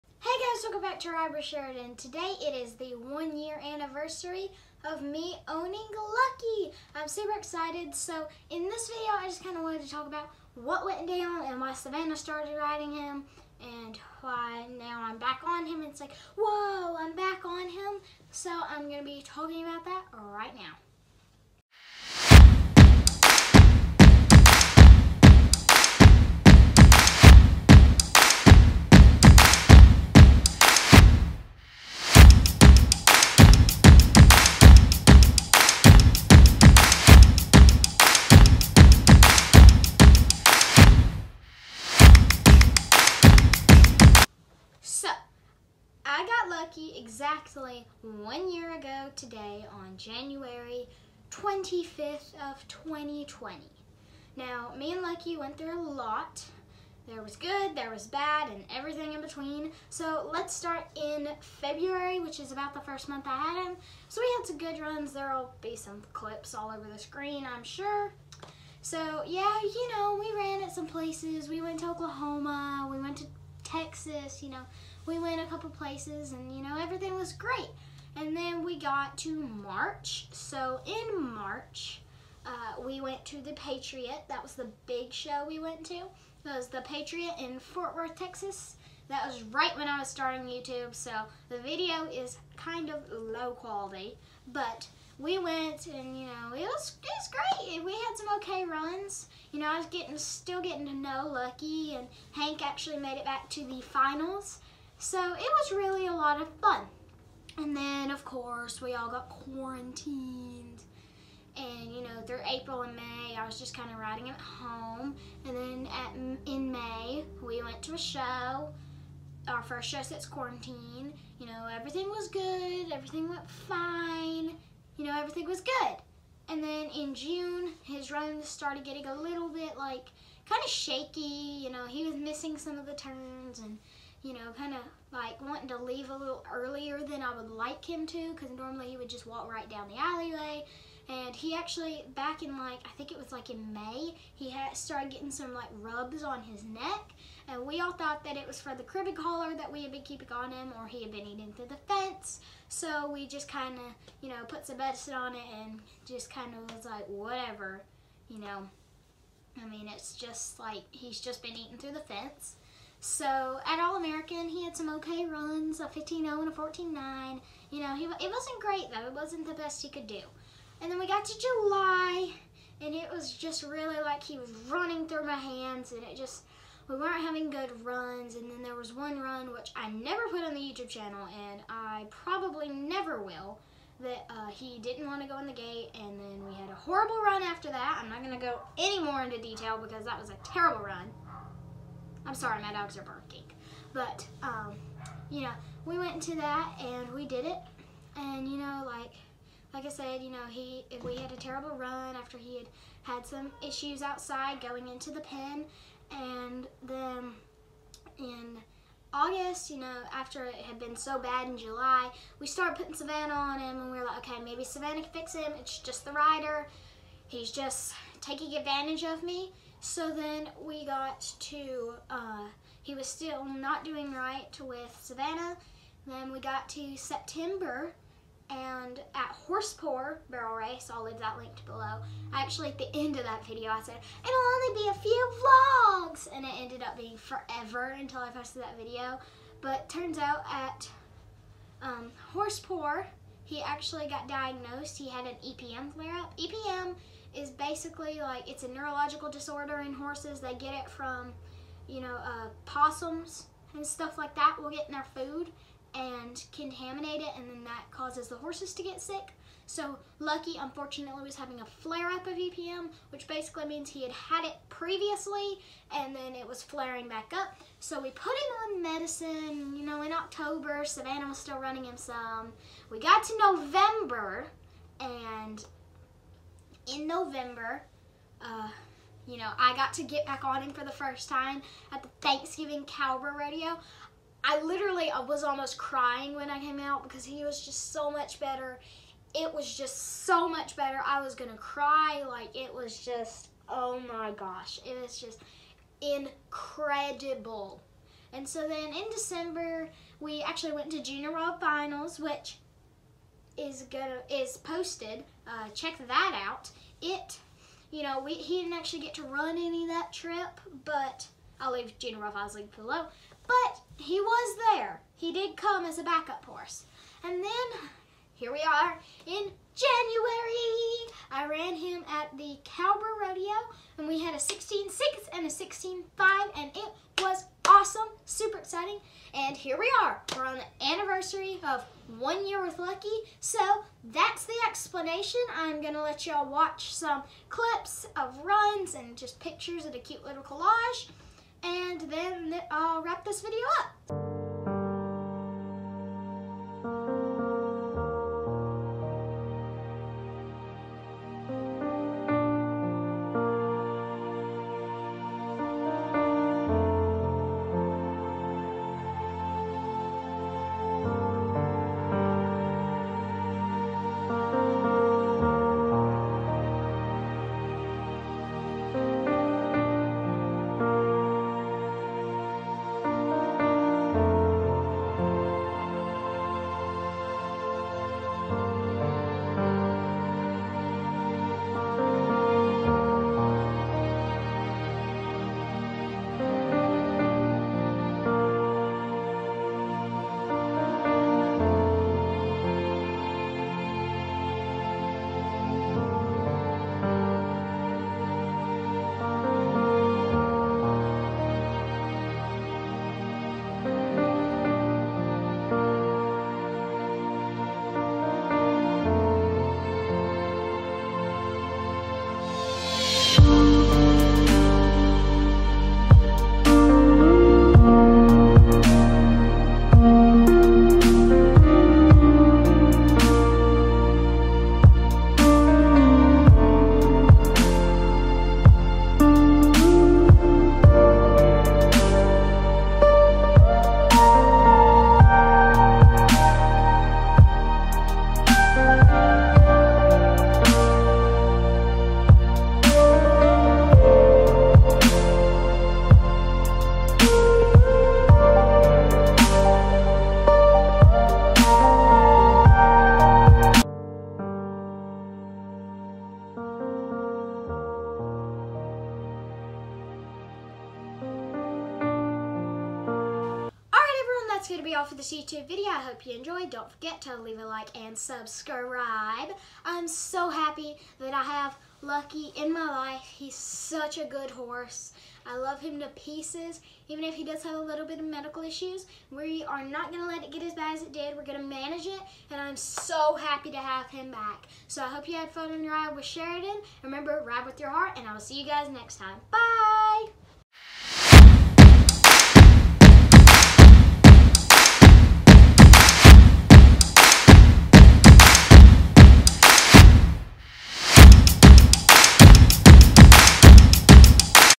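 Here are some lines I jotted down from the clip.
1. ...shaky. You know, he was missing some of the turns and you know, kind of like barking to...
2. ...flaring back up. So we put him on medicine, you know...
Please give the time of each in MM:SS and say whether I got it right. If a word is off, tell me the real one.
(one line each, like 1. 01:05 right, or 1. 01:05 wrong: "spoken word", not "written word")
1. 02:10 wrong: "wanting", not "barking"
2. 04:26 right.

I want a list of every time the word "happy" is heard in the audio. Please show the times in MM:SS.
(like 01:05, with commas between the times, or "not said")
07:50, 08:03.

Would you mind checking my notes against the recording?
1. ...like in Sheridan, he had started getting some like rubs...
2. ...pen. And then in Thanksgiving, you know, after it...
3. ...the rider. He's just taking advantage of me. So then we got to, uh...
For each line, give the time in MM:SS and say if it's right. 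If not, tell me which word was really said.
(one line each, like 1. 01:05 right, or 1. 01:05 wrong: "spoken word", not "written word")
1. 02:23 wrong: "May", not "Sheridan"
2. 03:25 wrong: "August", not "Thanksgiving"
3. 03:36 right.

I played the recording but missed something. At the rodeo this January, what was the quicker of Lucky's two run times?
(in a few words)
16.5.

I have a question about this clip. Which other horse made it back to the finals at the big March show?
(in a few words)
Hank.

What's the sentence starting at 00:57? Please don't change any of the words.
There was good, there was bad, and everything in between.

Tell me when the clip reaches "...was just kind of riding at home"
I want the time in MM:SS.
01:53.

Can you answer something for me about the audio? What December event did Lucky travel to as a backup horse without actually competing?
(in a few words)
Junior World Finals.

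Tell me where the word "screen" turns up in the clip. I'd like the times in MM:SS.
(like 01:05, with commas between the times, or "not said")
01:06.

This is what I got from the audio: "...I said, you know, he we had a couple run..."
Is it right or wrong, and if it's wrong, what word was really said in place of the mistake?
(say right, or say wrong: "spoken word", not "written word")
wrong: "terrible", not "couple".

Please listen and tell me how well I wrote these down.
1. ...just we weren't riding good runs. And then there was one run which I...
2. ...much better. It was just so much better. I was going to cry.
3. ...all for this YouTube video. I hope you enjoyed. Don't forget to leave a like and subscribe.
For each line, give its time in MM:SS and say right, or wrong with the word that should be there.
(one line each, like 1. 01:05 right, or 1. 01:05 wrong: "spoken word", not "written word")
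1. 02:56 wrong: "having", not "riding"
2. 04:48 right
3. 07:44 right.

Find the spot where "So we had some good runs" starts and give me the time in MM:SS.
01:04.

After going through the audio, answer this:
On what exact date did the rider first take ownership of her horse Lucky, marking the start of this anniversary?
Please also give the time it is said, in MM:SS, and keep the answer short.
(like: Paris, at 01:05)
January 25th, at 00:49.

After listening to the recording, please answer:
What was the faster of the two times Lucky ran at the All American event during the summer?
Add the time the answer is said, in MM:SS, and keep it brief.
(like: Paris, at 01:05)
14-9, at 02:46.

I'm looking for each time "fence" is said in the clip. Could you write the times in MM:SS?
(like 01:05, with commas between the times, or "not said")
02:31, 02:42.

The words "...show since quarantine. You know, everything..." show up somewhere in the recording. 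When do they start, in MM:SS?
01:59.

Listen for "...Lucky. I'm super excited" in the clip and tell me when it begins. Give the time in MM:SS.
00:05.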